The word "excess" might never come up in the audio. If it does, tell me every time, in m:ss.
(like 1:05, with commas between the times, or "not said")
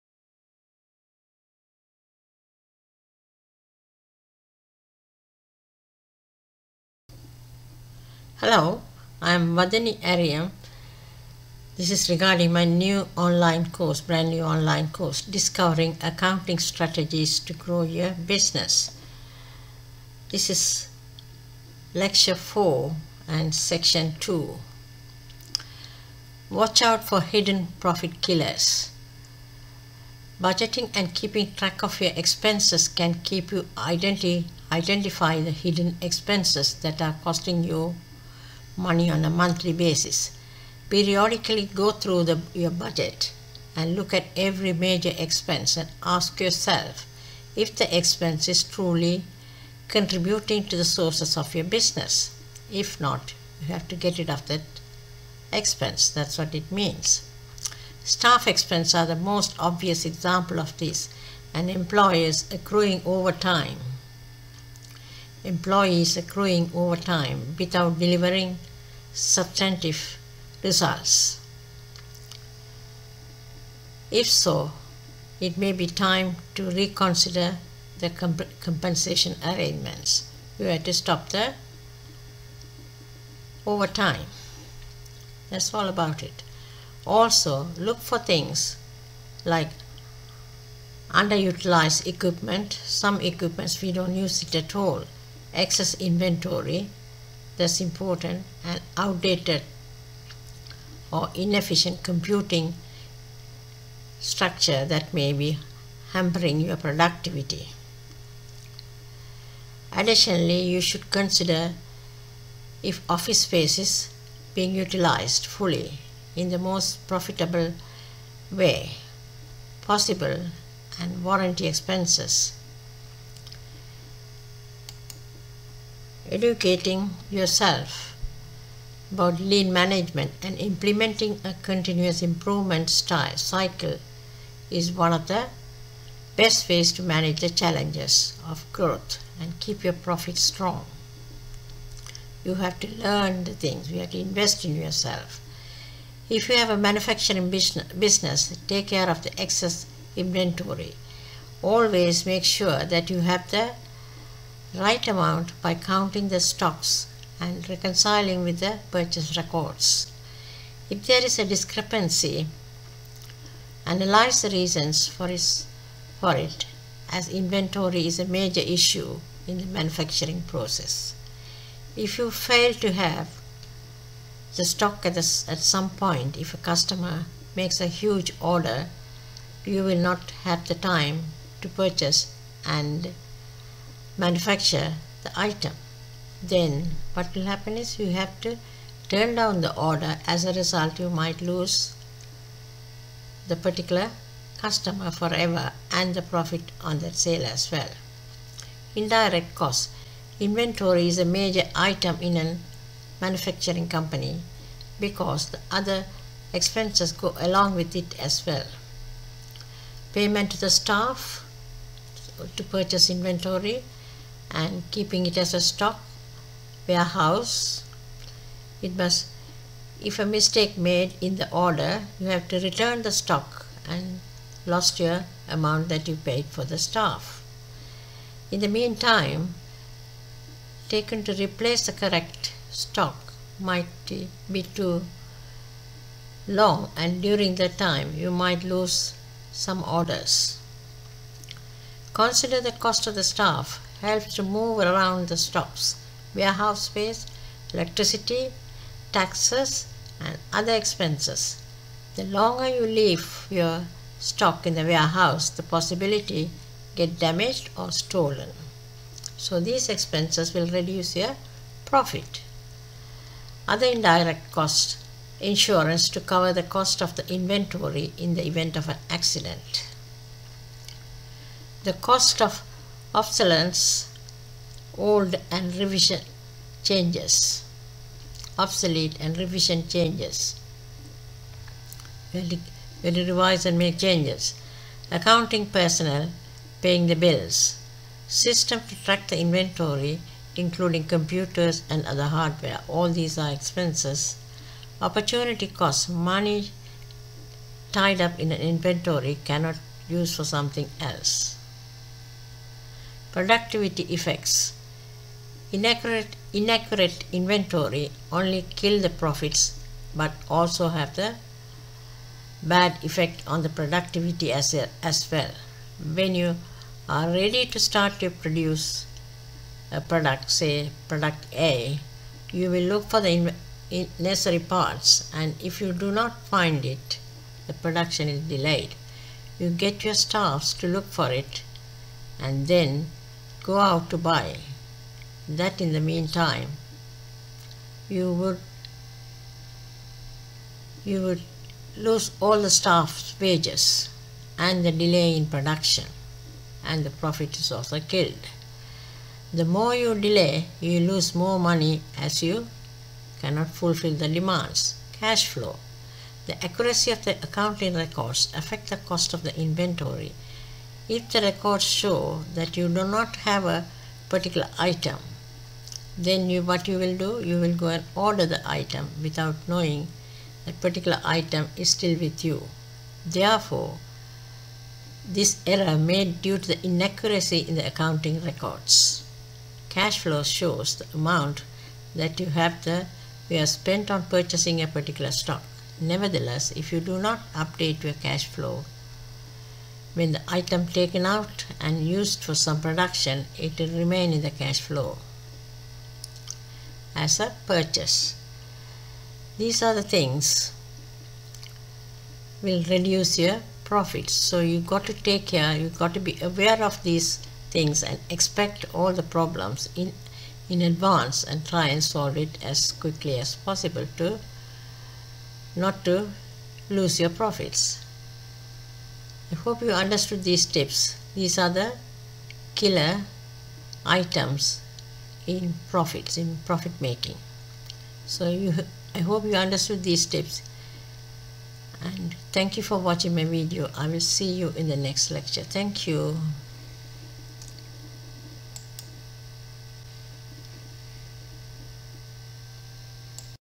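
1:35, 2:29.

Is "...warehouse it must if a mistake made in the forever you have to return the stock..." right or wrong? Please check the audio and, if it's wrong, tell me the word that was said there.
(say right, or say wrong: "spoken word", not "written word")
wrong: "order", not "forever".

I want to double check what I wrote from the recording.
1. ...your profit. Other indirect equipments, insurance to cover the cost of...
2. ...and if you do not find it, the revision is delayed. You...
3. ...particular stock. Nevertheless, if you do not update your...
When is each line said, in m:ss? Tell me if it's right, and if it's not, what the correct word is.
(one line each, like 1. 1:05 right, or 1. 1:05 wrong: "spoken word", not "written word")
1. 4:21 wrong: "costs", not "equipments"
2. 5:25 wrong: "production", not "revision"
3. 6:24 right.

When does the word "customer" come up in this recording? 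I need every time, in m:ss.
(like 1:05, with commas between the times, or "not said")
2:56, 3:14.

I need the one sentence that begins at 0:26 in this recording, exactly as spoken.
Watch out for hidden profit killers.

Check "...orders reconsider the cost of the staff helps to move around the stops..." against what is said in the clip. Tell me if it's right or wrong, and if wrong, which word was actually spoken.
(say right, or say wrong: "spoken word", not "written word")
wrong: "consider", not "reconsider".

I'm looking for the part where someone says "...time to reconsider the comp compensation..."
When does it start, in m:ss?
1:15.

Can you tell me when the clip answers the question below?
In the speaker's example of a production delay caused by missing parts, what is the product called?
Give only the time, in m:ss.
5:21.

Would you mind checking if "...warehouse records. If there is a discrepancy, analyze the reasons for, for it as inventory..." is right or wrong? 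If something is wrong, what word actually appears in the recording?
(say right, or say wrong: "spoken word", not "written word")
wrong: "purchase", not "warehouse".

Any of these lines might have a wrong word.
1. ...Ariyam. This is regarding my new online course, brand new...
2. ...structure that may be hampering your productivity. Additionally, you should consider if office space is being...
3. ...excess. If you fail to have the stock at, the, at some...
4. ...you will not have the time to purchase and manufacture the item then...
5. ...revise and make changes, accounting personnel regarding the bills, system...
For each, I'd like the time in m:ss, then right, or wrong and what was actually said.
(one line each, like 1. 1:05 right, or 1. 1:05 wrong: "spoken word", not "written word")
1. 0:10 right
2. 1:44 right
3. 2:50 wrong: "process", not "excess"
4. 2:59 right
5. 4:43 wrong: "paying", not "regarding".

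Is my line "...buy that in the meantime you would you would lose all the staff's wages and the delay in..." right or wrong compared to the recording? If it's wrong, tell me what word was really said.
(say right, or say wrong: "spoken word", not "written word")
right.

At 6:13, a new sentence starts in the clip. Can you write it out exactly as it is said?
Therefore, this error made due to the inaccuracy in the accounting records.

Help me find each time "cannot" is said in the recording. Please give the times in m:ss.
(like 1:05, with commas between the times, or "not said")
4:59, 5:53.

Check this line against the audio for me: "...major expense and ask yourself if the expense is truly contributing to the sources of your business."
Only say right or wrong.
right.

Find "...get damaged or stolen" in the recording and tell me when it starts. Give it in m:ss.
4:16.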